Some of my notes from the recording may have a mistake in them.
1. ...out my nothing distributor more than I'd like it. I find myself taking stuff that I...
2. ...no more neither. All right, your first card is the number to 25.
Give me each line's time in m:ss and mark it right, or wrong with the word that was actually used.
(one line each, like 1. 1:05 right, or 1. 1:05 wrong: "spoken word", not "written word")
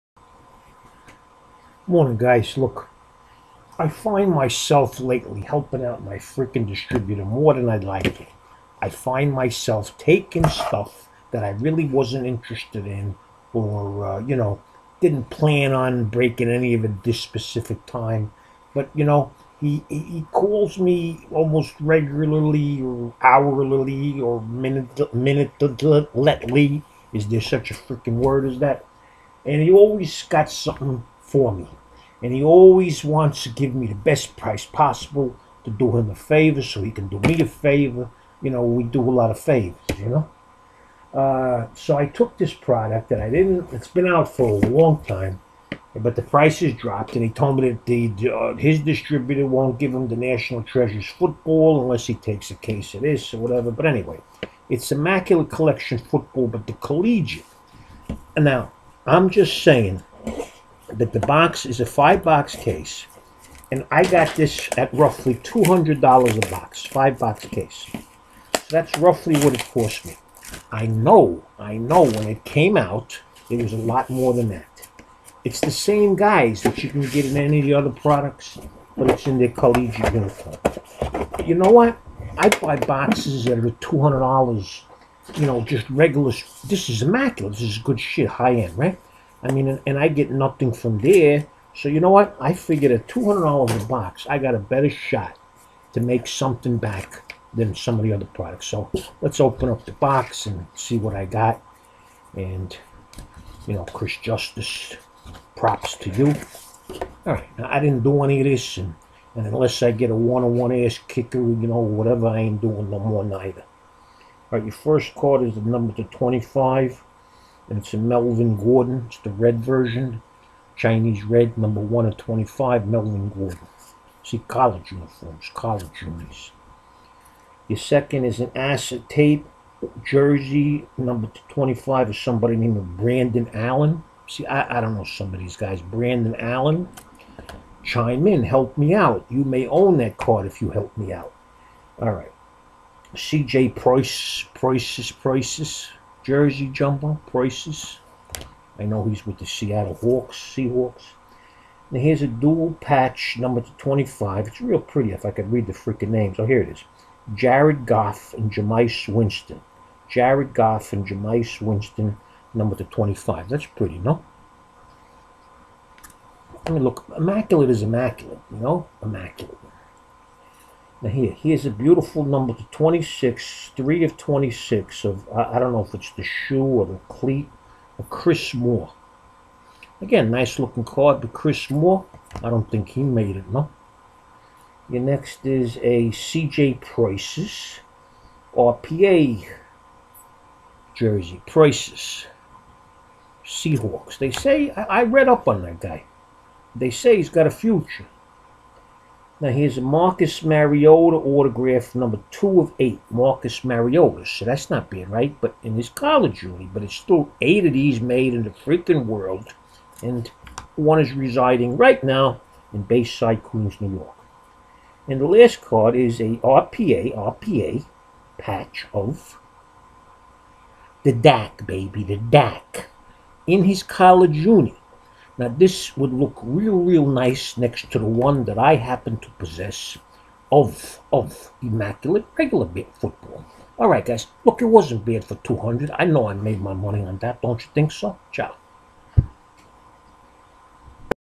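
1. 0:05 wrong: "freaking", not "nothing"
2. 1:52 right.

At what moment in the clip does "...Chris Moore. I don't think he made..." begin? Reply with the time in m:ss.
3:01.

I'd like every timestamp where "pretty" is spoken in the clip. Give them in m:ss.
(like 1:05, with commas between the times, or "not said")
2:34, 2:43.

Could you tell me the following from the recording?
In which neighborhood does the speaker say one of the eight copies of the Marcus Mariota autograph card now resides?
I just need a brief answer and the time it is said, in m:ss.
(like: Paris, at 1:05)
Bayside, at 3:32.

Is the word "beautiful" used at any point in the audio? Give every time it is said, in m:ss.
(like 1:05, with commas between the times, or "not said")
2:51.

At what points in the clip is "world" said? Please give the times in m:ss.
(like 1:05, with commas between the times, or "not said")
3:29.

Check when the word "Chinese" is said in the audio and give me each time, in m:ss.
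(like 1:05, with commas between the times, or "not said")
2:00.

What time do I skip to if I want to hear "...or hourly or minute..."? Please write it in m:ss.
0:22.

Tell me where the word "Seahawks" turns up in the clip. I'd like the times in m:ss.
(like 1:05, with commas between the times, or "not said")
2:30, 3:13.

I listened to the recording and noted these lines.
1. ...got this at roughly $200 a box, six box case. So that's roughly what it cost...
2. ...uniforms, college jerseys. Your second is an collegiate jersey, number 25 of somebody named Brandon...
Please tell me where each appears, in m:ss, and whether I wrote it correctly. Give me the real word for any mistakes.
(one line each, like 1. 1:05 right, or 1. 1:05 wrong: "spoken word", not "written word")
1. 1:04 wrong: "five", not "six"
2. 2:04 wrong: "acetate", not "collegiate".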